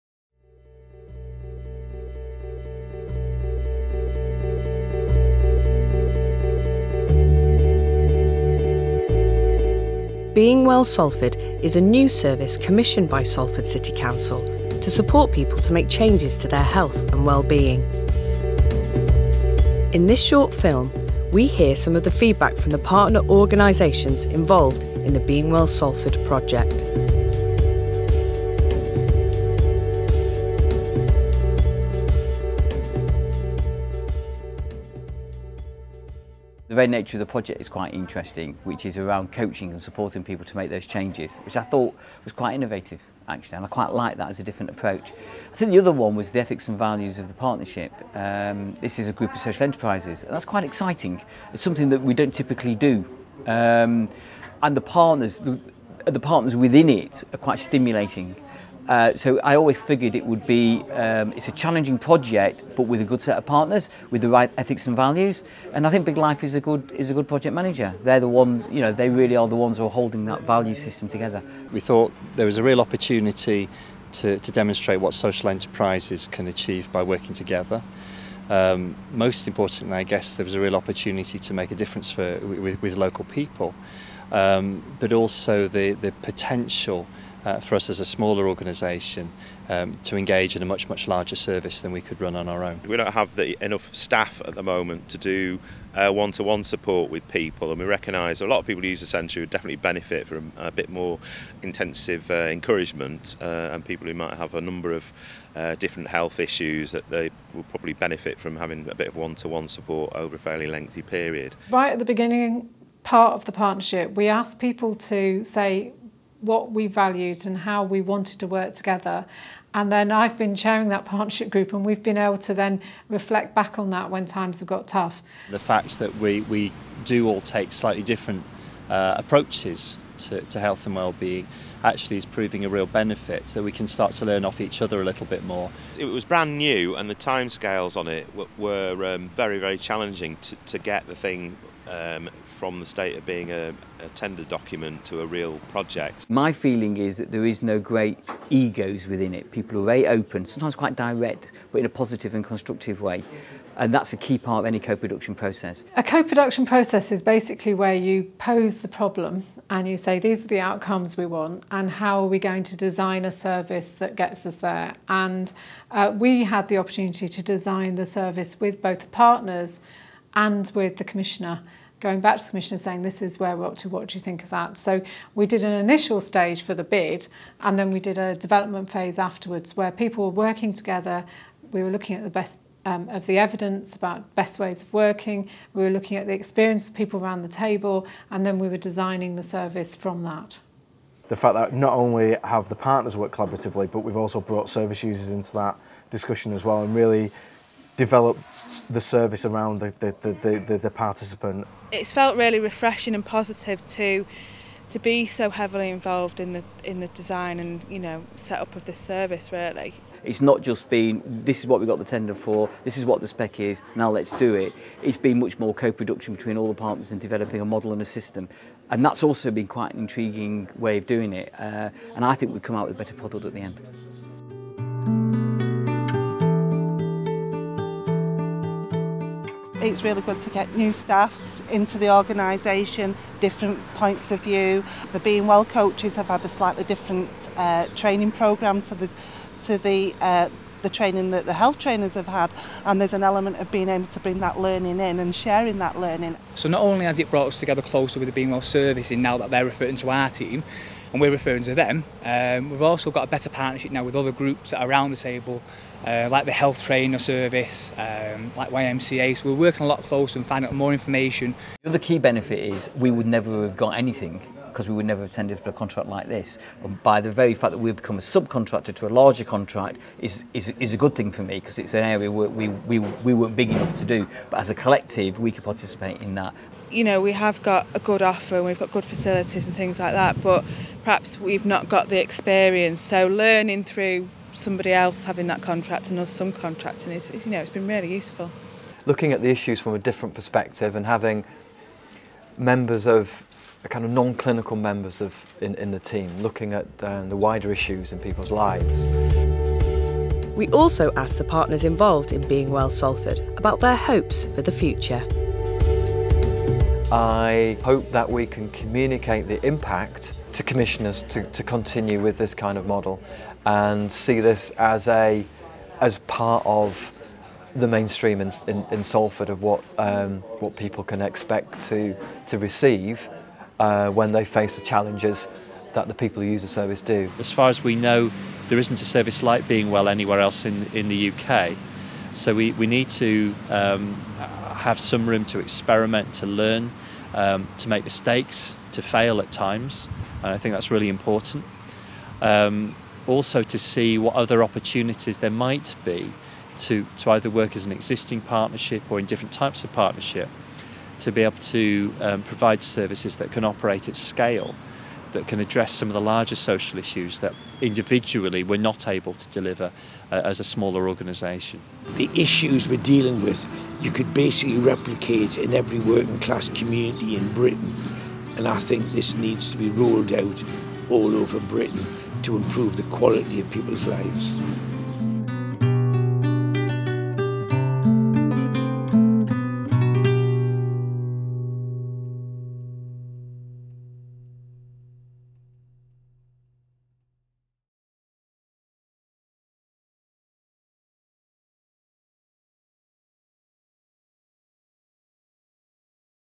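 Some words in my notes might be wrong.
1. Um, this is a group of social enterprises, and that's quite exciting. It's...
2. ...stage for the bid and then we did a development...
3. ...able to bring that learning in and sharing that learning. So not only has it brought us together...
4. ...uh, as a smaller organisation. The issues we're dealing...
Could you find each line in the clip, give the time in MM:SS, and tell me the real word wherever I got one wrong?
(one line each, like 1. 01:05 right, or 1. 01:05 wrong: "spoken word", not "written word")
1. 00:48 right
2. 02:56 right
3. 04:03 right
4. 06:00 right.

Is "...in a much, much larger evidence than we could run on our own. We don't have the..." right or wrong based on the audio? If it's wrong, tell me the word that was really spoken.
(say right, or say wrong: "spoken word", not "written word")
wrong: "service", not "evidence".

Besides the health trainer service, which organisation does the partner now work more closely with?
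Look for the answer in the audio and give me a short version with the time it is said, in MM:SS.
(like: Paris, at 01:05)
YMCA, at 04:18.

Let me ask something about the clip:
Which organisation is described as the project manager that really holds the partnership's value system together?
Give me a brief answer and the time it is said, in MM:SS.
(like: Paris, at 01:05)
Big Life, at 01:06.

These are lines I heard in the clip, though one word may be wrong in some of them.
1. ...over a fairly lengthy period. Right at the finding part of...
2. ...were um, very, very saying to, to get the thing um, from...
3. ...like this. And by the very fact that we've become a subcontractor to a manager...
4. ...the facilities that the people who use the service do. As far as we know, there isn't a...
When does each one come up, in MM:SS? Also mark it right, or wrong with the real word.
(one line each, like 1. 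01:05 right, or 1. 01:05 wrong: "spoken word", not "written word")
1. 01:50 wrong: "beginning", not "finding"
2. 02:18 wrong: "challenging", not "saying"
3. 04:26 wrong: "larger", not "manager"
4. 05:24 wrong: "challenges", not "facilities".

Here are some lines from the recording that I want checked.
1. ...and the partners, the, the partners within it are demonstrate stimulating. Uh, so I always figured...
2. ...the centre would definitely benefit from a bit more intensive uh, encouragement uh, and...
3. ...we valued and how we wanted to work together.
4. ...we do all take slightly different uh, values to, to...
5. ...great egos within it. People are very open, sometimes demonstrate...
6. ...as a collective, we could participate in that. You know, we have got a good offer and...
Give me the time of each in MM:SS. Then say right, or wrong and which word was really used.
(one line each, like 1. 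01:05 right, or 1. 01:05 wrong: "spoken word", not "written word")
1. 00:54 wrong: "quite", not "demonstrate"
2. 01:39 right
3. 01:56 right
4. 02:06 wrong: "approaches", not "values"
5. 02:27 wrong: "quite", not "demonstrate"
6. 04:34 right.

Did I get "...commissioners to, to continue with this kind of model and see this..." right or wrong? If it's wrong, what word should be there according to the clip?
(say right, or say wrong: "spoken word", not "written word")
right.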